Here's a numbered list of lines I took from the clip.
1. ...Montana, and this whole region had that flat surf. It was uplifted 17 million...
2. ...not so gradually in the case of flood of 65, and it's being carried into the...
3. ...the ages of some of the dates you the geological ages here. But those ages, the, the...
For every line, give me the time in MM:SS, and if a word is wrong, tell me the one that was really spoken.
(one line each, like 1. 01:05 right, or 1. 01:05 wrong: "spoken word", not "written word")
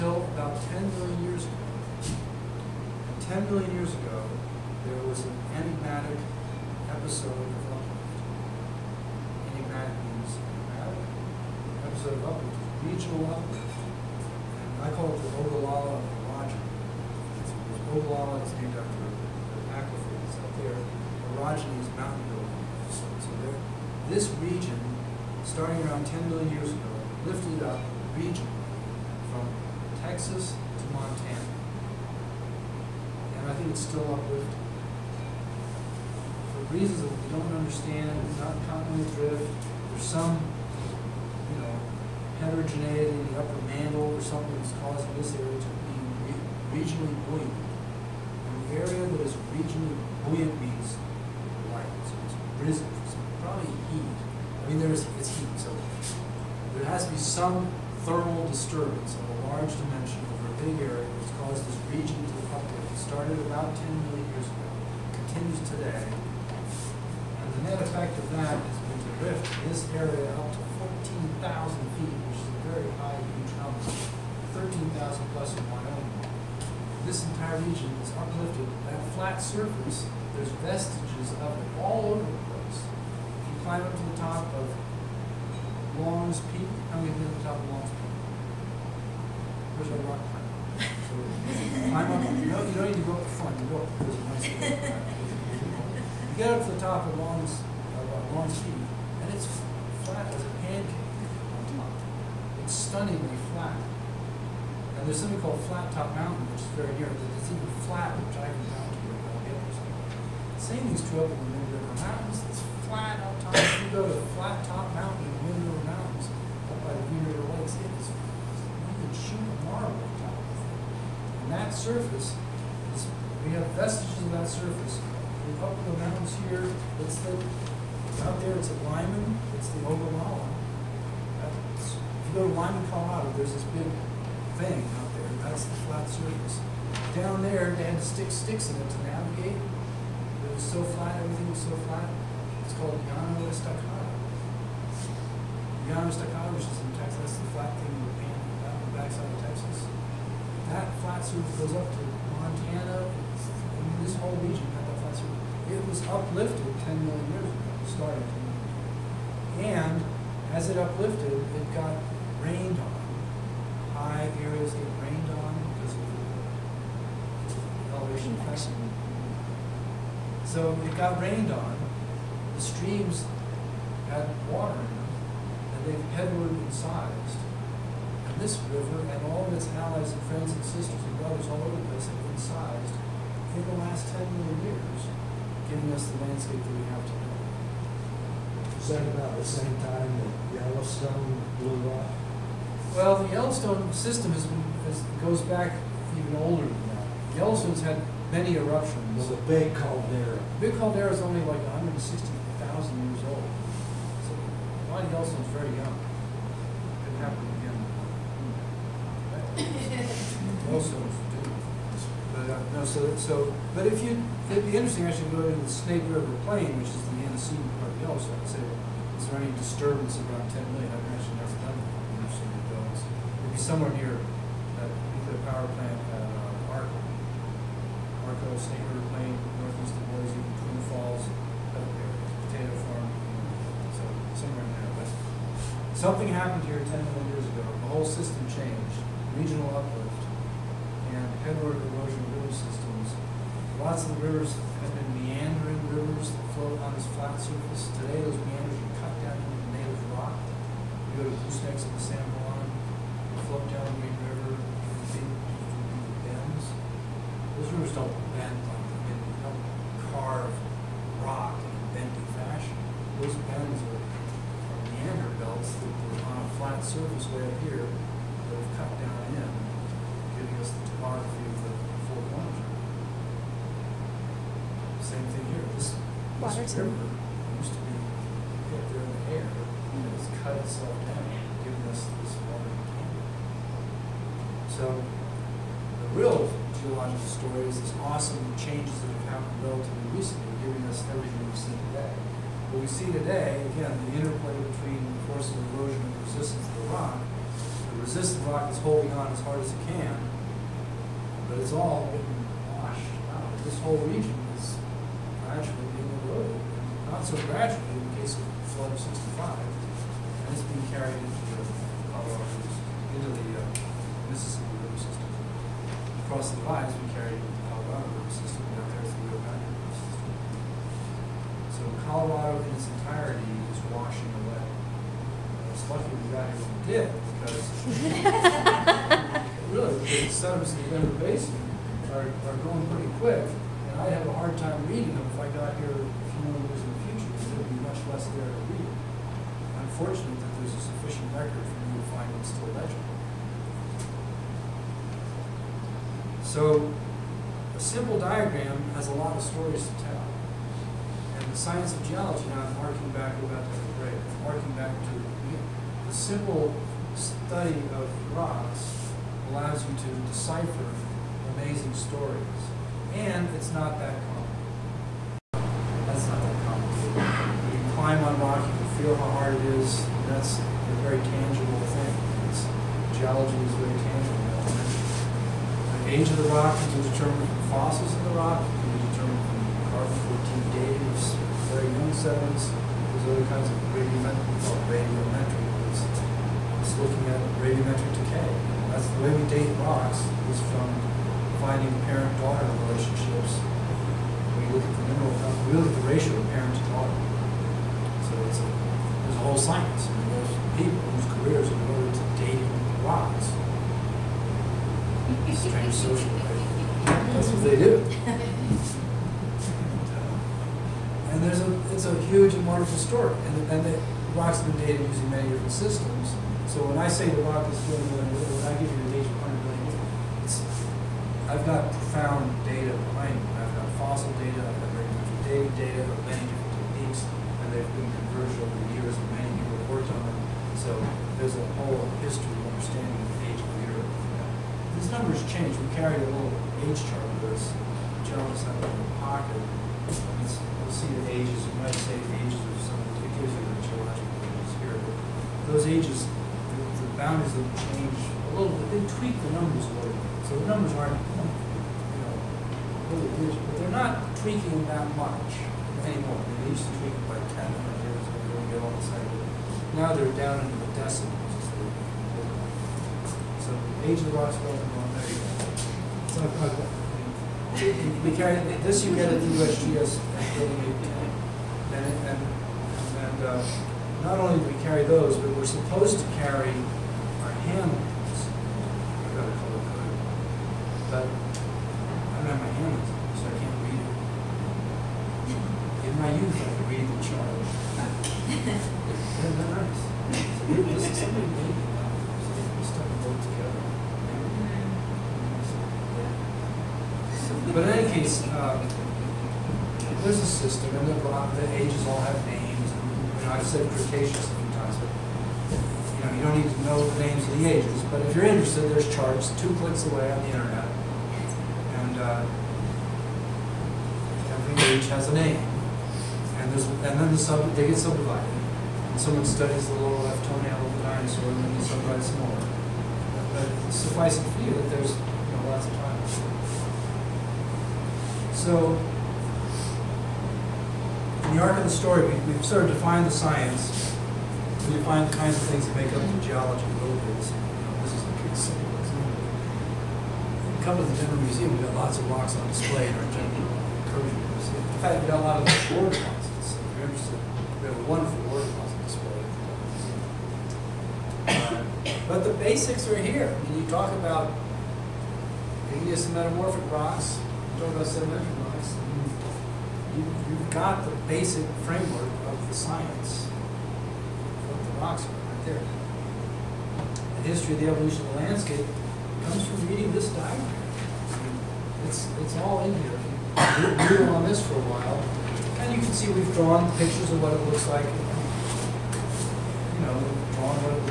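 1. 02:32 wrong: "10", not "17"
2. 05:07 right
3. 07:22 wrong: "gives", not "dates".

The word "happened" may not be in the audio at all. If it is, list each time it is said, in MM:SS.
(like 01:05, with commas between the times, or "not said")
03:27, 03:56, 04:49.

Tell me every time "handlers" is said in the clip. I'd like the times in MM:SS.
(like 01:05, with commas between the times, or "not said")
07:57.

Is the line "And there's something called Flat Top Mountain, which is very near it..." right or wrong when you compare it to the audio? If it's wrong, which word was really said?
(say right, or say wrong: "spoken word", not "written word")
right.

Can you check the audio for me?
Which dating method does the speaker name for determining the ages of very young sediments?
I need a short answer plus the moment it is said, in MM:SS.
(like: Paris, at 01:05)
Carbon 14, at 06:19.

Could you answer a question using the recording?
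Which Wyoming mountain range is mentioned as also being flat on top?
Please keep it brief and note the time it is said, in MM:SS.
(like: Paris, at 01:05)
Wind River Mountains, at 01:51.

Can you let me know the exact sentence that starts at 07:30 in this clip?
So the numbers aren't, you know, really rigid, but they're not tweaking that much anymore.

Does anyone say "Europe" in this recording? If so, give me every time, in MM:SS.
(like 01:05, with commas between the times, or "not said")
07:13.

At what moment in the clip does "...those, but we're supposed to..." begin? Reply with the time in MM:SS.
07:55.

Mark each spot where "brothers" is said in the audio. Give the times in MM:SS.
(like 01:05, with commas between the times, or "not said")
03:01.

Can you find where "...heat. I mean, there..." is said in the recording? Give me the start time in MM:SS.
00:53.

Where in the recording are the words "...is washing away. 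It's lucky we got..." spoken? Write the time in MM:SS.
05:23.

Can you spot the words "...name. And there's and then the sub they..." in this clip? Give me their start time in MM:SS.
08:35.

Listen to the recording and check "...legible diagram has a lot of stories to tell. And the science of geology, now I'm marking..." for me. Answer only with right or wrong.
wrong.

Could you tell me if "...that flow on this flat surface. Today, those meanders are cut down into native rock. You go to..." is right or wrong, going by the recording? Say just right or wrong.
right.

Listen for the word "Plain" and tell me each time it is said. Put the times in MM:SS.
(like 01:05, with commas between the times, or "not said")
03:36, 03:49.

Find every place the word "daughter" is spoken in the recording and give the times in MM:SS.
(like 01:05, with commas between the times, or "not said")
06:32, 06:36.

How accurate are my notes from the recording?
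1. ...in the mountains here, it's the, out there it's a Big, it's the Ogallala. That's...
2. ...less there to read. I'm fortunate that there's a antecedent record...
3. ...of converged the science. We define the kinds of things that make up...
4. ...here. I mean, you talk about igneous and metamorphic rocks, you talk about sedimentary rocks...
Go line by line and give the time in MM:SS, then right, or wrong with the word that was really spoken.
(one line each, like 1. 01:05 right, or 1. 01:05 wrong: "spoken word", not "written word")
1. 02:05 wrong: "Limon", not "Big"
2. 05:38 wrong: "sufficient", not "antecedent"
3. 08:52 wrong: "defined", not "converged"
4. 09:13 right.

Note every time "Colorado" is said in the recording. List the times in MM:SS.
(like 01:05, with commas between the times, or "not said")
02:12, 05:12, 05:17, 05:22.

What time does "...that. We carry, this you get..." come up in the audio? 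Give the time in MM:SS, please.
07:46.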